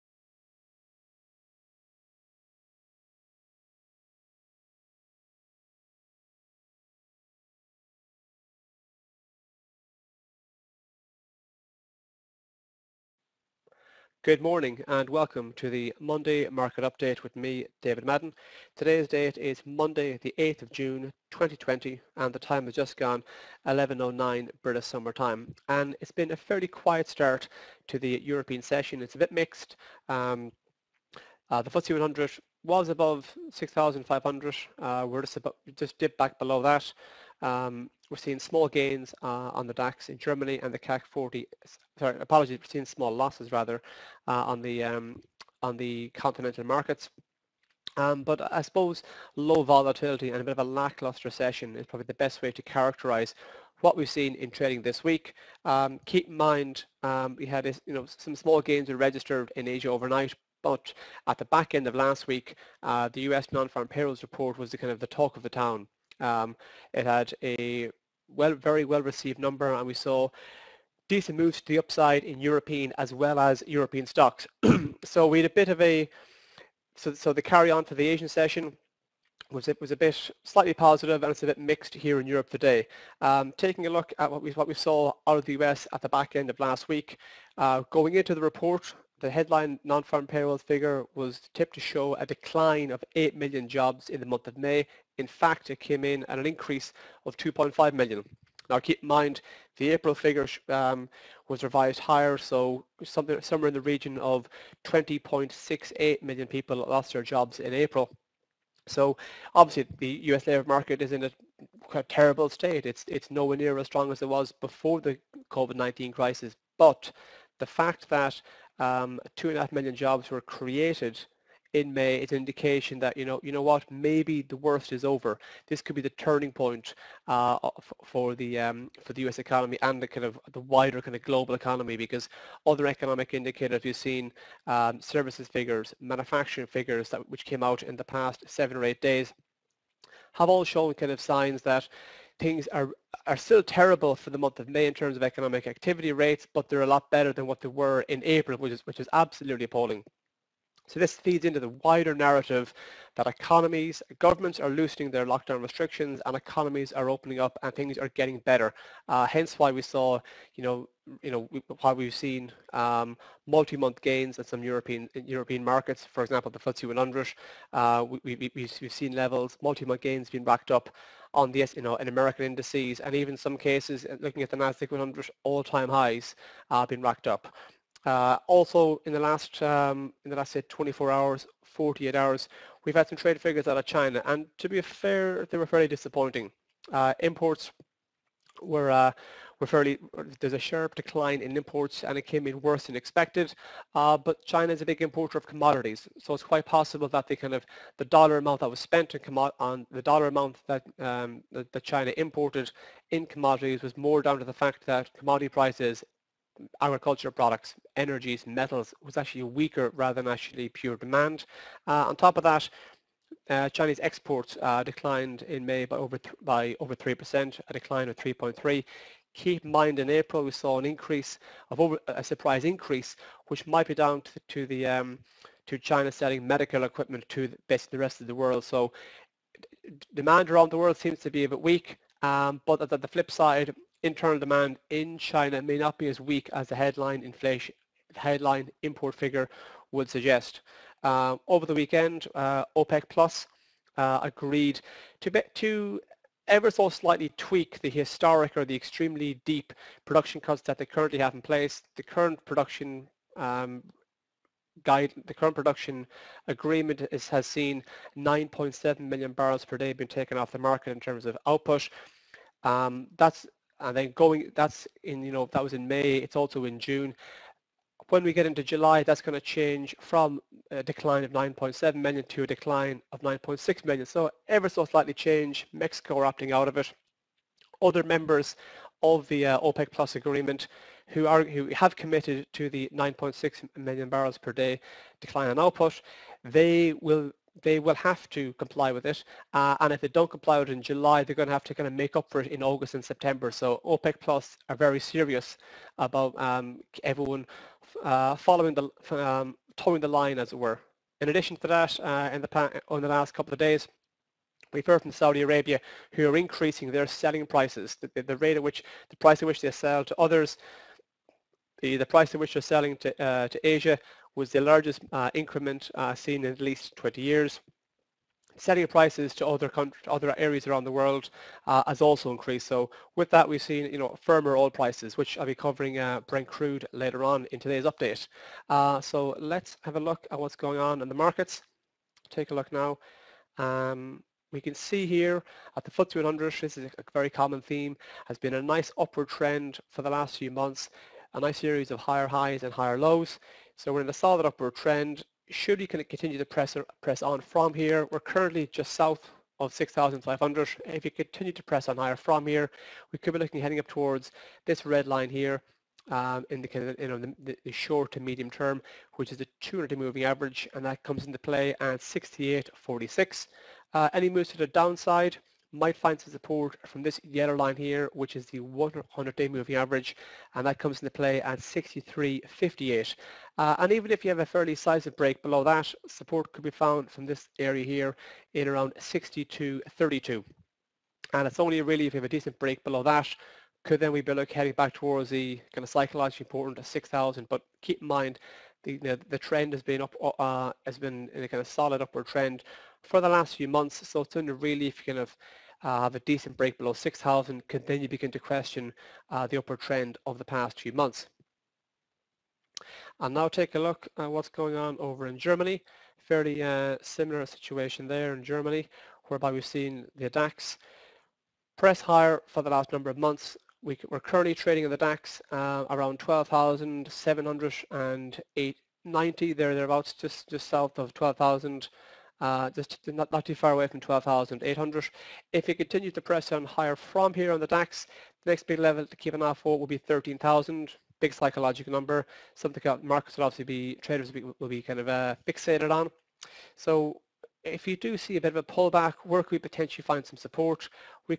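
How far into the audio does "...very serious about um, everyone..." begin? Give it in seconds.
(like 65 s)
294 s.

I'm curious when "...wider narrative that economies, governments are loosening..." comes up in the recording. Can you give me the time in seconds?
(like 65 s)
151 s.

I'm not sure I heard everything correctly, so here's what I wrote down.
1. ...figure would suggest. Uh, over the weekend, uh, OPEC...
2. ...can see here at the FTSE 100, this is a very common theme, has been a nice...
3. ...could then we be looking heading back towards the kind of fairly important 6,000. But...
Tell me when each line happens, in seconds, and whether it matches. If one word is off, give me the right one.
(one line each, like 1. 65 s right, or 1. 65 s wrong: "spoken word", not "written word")
1. 239 s right
2. 334 s right
3. 383 s wrong: "psychologically", not "fairly".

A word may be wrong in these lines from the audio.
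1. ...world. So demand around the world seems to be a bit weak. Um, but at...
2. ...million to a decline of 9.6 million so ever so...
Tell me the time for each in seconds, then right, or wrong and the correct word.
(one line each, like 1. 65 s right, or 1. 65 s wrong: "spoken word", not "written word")
1. 228 s right
2. 271 s right.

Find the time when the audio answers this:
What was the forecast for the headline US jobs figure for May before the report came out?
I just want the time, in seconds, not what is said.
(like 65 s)
92 s.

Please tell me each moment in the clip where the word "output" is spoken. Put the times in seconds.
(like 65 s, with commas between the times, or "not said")
261 s, 285 s.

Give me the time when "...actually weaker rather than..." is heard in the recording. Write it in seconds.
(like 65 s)
209 s.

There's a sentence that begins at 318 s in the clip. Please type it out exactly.
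Setting prices to other other areas around the world uh, has also increased.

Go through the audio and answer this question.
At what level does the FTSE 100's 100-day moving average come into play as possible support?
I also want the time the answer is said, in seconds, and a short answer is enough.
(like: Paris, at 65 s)
6358, at 371 s.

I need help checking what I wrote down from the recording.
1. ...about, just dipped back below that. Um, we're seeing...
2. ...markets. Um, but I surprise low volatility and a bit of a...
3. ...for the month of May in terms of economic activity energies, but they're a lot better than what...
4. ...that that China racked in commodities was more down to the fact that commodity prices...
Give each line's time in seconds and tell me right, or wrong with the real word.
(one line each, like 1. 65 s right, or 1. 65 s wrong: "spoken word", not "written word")
1. 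35 s right
2. 46 s wrong: "suppose", not "surprise"
3. 144 s wrong: "rates", not "energies"
4. 201 s wrong: "imported", not "racked".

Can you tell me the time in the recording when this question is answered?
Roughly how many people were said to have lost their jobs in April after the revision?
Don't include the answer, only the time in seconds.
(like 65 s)
104 s.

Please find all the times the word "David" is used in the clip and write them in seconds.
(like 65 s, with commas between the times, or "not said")
17 s.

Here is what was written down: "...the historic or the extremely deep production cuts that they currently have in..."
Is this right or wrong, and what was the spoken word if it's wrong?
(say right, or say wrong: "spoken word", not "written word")
right.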